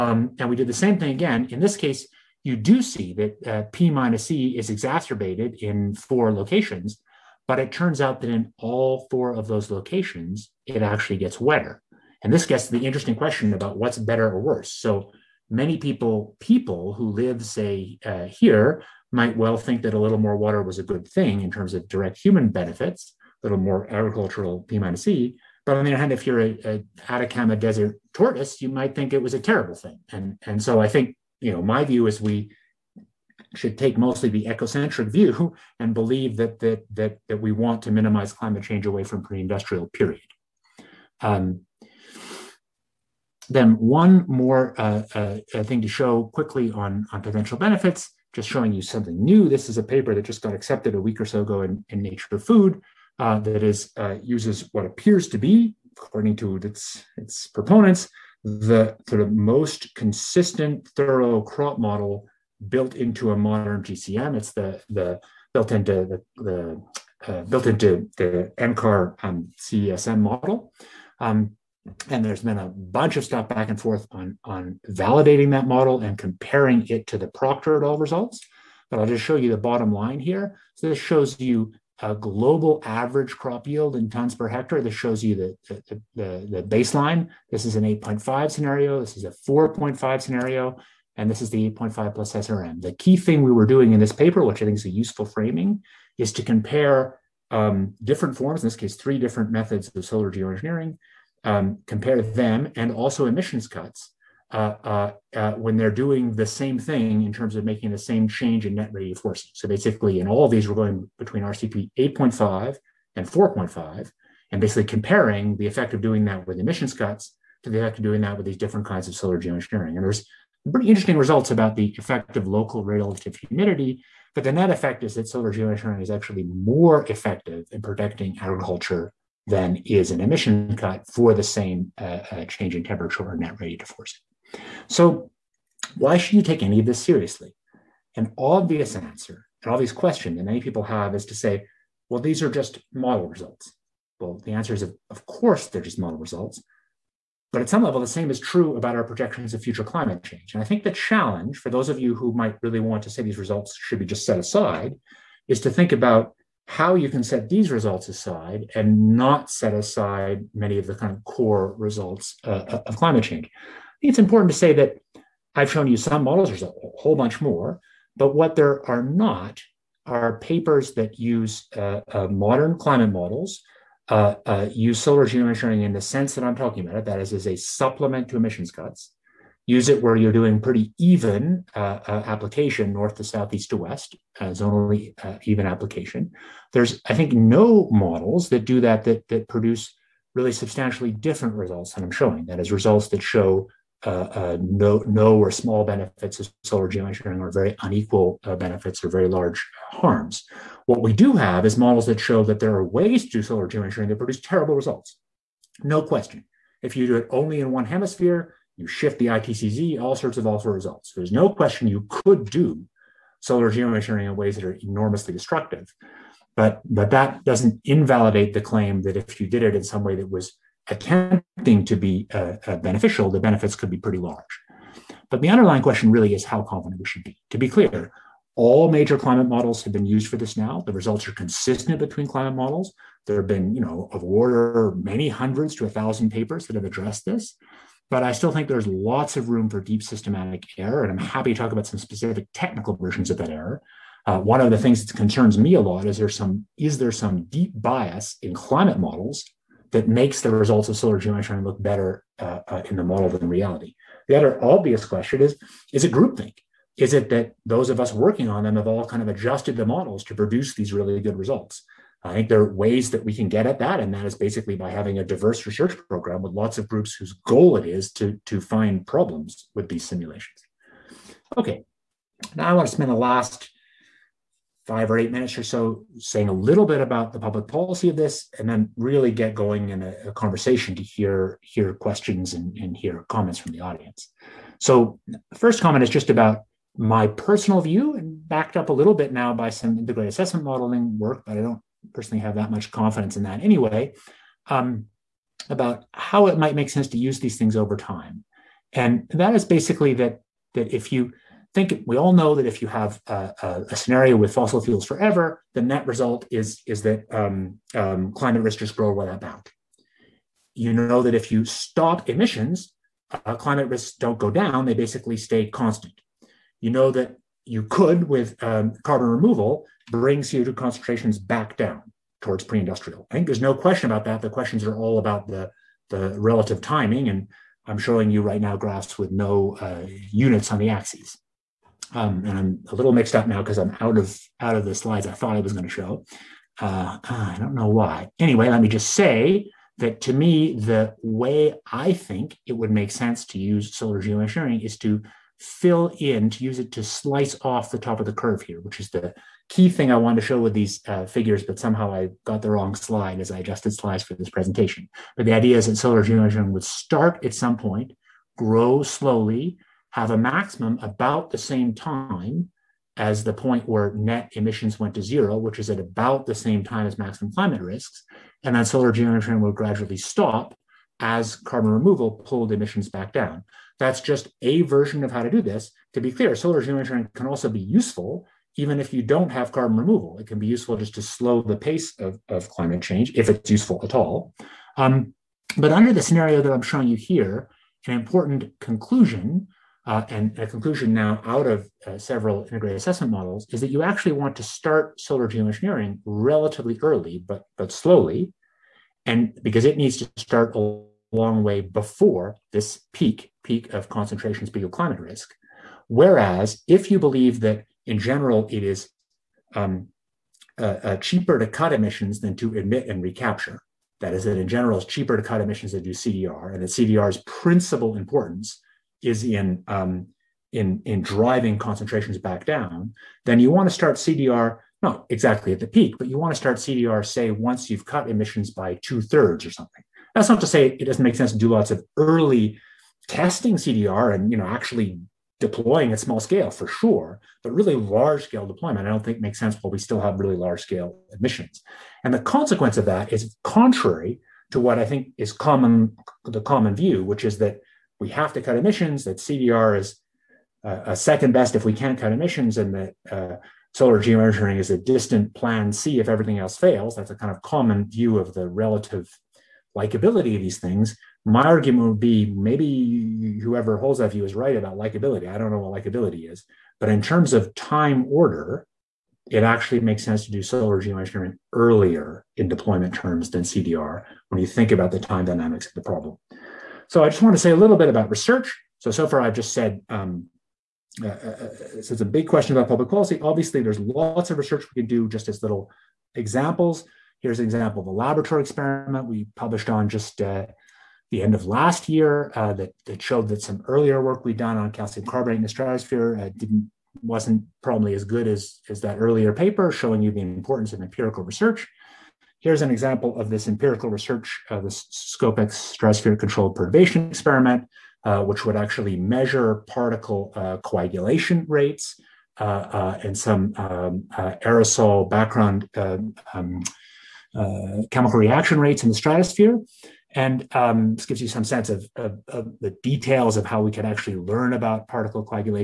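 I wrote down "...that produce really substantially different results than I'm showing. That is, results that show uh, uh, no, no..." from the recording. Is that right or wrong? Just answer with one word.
right.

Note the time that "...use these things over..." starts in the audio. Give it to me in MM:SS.
04:57.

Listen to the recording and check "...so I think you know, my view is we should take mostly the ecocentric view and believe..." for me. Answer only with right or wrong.
right.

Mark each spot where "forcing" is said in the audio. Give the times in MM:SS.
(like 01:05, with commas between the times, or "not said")
01:49, 02:13.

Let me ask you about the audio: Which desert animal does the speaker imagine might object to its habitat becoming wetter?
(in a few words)
Atacama Desert tortoise.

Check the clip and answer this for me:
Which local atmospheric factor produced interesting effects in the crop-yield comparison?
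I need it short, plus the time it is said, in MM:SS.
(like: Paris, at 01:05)
relative humidity, at 02:02.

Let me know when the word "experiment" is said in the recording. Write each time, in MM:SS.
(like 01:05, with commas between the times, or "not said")
08:08, 08:27.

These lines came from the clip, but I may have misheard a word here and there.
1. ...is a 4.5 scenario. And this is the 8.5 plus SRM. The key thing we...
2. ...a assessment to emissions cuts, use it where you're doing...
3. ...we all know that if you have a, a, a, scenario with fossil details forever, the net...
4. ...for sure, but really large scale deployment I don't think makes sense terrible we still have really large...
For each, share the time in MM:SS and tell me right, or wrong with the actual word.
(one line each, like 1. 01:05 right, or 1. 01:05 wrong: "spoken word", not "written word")
1. 01:29 right
2. 02:57 wrong: "supplement", not "assessment"
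3. 05:02 wrong: "fuels", not "details"
4. 07:16 wrong: "while", not "terrible".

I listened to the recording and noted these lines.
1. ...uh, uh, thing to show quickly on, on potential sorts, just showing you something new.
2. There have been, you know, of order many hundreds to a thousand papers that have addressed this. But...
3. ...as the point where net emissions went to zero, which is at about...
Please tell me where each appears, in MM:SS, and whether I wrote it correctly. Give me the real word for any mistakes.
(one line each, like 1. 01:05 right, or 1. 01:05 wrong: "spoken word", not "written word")
1. 00:44 wrong: "benefits", not "sorts"
2. 03:53 right
3. 06:03 right.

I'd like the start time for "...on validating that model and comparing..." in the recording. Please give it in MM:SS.
01:14.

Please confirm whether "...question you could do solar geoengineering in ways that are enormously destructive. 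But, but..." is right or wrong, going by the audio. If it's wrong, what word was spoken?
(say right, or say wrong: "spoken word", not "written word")
right.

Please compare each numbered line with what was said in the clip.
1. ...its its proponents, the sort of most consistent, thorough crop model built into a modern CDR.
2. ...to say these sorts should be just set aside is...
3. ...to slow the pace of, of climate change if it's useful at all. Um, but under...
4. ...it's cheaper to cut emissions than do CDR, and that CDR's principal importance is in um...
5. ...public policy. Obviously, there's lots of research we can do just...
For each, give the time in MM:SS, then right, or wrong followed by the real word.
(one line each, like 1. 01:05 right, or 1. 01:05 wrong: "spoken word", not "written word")
1. 00:56 wrong: "GCM", not "CDR"
2. 02:33 wrong: "results", not "sorts"
3. 06:21 right
4. 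06:54 right
5. 08:02 right.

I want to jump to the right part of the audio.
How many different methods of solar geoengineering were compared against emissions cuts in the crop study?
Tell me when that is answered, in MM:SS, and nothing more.
01:38.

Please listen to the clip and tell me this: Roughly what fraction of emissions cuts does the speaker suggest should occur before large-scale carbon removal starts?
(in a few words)
two thirds.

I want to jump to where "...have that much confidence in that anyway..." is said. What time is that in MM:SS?
04:52.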